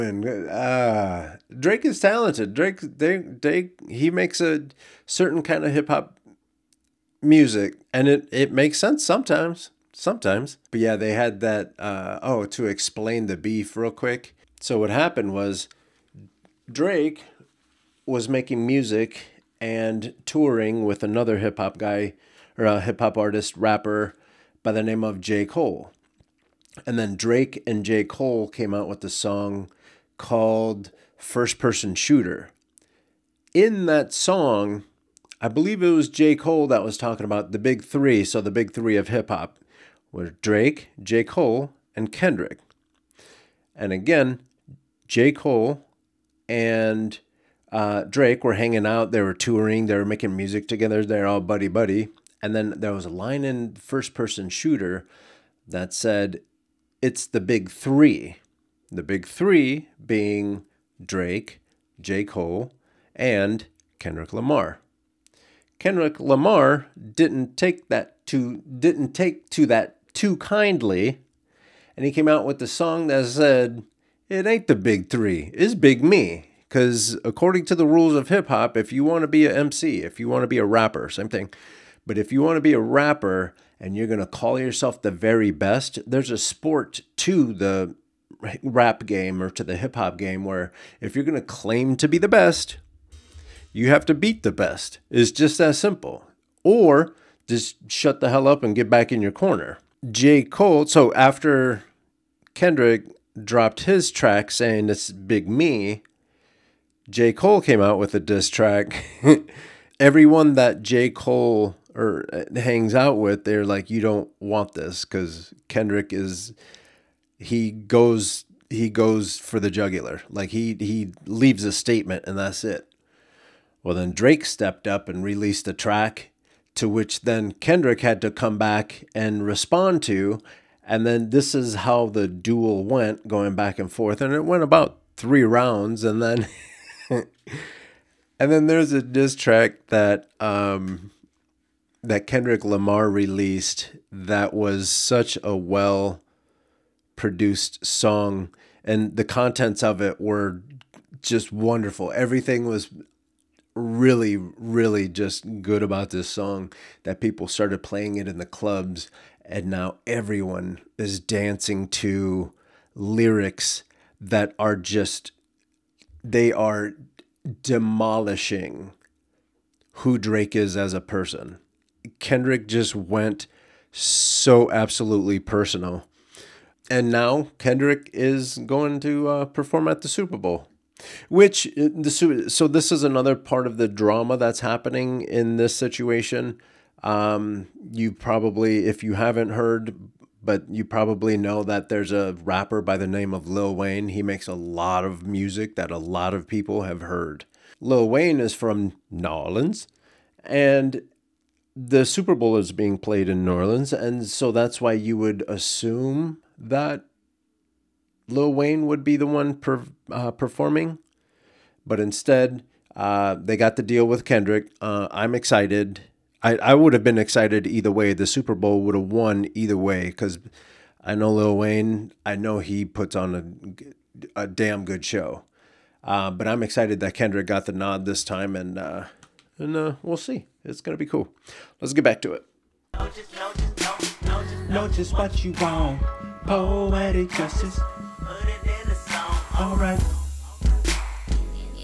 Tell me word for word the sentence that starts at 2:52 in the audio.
Kendrick just went so absolutely personal.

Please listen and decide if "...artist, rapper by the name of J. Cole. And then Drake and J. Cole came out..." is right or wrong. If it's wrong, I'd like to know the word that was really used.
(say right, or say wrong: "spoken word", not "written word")
right.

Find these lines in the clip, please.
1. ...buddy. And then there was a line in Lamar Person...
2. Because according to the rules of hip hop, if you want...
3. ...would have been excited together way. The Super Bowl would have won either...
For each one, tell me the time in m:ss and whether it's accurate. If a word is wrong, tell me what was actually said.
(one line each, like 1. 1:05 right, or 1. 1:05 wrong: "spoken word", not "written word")
1. 0:51 wrong: "First", not "Lamar"
2. 1:16 right
3. 3:36 wrong: "either", not "together".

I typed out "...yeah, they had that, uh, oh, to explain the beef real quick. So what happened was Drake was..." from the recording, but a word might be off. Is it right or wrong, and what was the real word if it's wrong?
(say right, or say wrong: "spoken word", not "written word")
right.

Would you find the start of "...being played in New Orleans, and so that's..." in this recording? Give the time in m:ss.
3:22.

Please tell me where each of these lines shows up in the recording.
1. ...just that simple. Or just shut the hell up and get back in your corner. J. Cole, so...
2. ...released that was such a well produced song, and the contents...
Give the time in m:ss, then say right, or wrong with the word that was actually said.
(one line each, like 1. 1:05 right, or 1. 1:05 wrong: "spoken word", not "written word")
1. 1:35 right
2. 2:23 right.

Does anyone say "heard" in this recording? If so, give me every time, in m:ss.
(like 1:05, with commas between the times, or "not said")
3:09, 3:17.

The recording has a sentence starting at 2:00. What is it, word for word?
Like he he leaves a statement and that's it.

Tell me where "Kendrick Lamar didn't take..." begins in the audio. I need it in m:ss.
1:05.